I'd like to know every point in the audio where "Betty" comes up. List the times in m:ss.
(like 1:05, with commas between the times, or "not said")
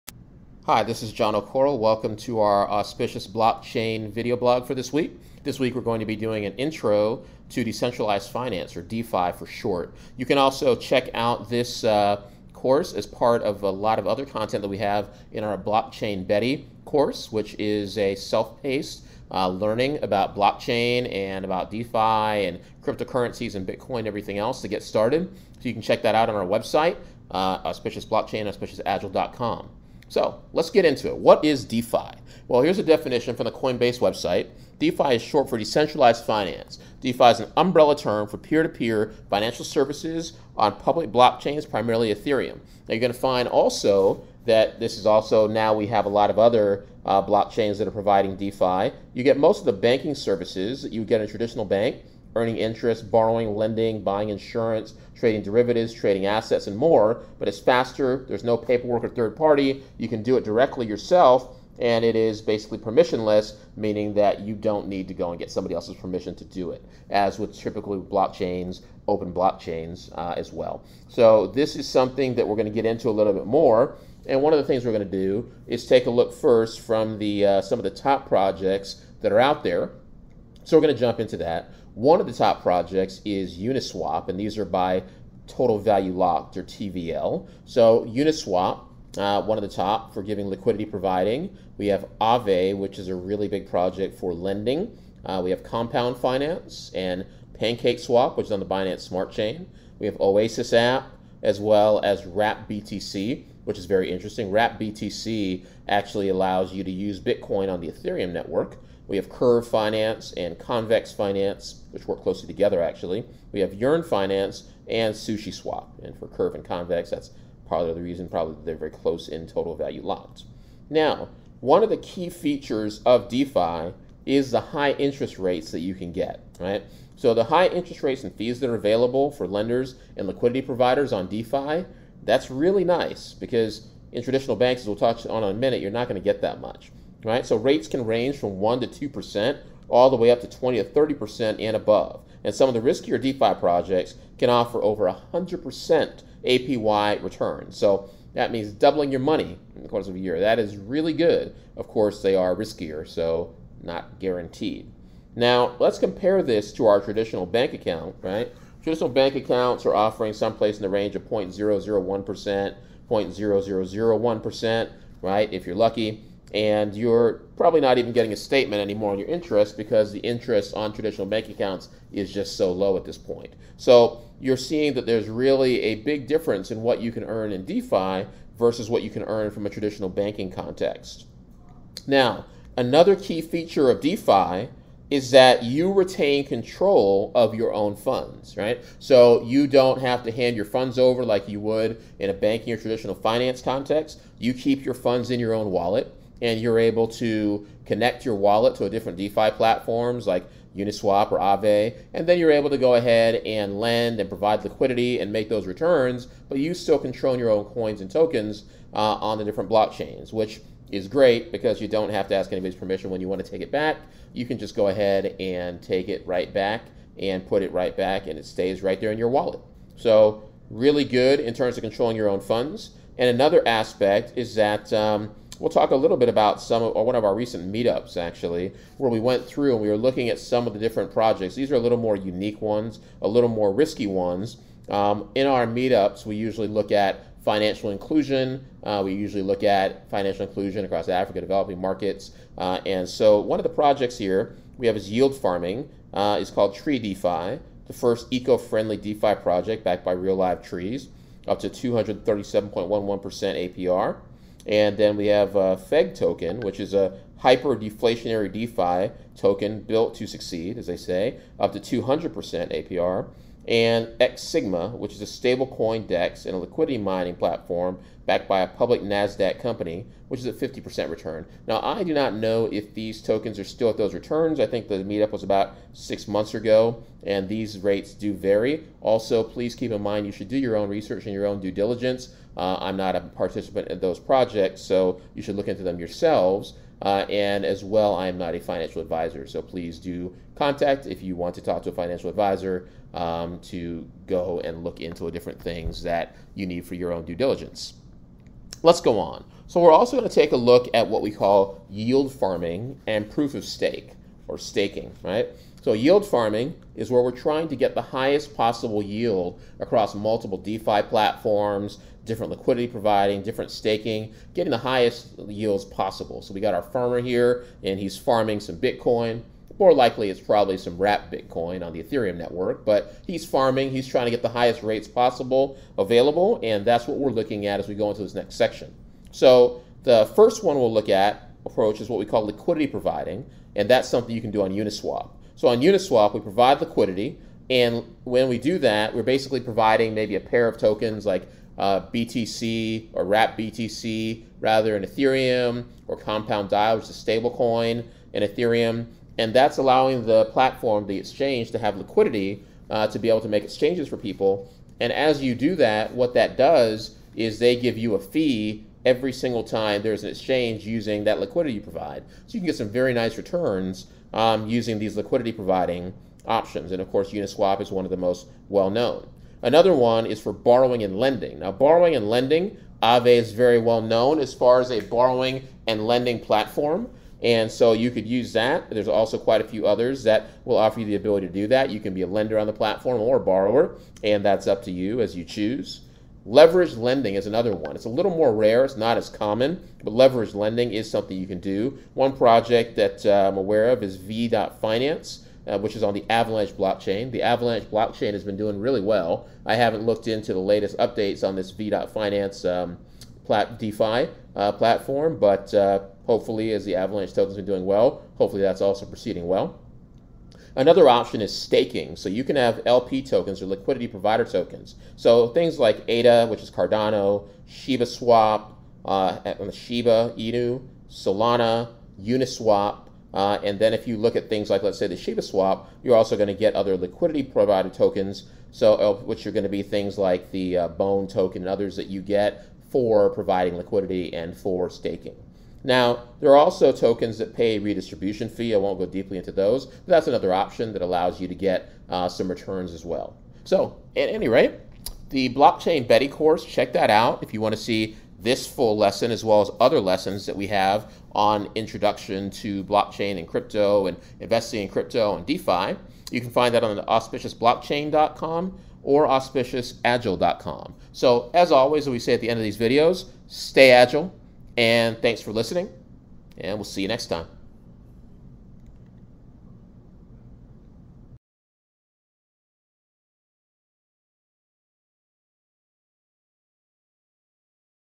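0:16, 7:26.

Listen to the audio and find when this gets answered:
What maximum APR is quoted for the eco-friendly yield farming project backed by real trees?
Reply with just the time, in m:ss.
4:11.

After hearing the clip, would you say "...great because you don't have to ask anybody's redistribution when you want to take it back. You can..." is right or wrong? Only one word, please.
wrong.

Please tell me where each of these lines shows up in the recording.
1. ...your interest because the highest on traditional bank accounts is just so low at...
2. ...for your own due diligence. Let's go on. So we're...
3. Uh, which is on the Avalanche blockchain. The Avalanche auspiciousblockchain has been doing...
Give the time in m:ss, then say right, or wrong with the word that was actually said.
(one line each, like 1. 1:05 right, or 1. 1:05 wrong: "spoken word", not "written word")
1. 2:49 wrong: "interest", not "highest"
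2. 4:56 right
3. 6:35 wrong: "blockchain", not "auspiciousblockchain".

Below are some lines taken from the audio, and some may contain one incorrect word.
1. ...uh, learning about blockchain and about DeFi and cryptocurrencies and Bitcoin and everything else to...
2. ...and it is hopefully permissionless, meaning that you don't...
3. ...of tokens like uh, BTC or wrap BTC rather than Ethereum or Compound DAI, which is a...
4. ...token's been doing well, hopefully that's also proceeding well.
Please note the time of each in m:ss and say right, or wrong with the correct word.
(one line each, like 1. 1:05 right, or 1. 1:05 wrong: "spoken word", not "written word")
1. 0:19 right
2. 1:01 wrong: "basically", not "hopefully"
3. 5:40 right
4. 6:47 right.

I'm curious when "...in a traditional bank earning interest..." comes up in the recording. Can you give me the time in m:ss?
0:51.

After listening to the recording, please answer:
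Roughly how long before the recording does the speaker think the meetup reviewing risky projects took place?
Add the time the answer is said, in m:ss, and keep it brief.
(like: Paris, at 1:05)
About six months, at 4:35.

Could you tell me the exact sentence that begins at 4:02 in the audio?
Uh, and so one of the projects here we have is yield farming.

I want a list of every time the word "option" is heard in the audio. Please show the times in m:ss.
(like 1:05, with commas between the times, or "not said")
6:06, 6:51, 7:20.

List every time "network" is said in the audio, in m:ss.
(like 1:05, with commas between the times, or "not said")
1:48, 5:22.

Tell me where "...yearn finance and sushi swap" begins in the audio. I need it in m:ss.
1:53.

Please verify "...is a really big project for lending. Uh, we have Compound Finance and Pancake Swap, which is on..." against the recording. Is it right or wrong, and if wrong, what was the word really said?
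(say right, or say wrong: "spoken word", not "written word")
right.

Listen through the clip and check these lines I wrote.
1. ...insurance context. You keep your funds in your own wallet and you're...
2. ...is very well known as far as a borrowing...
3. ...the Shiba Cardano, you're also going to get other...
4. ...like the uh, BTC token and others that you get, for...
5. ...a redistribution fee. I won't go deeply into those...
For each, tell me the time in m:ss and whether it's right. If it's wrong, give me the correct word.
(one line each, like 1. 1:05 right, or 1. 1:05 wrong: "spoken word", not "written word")
1. 3:13 wrong: "finance", not "insurance"
2. 6:13 right
3. 7:05 wrong: "Swap", not "Cardano"
4. 7:10 wrong: "Bone", not "BTC"
5. 7:17 right.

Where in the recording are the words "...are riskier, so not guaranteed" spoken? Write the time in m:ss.
2:32.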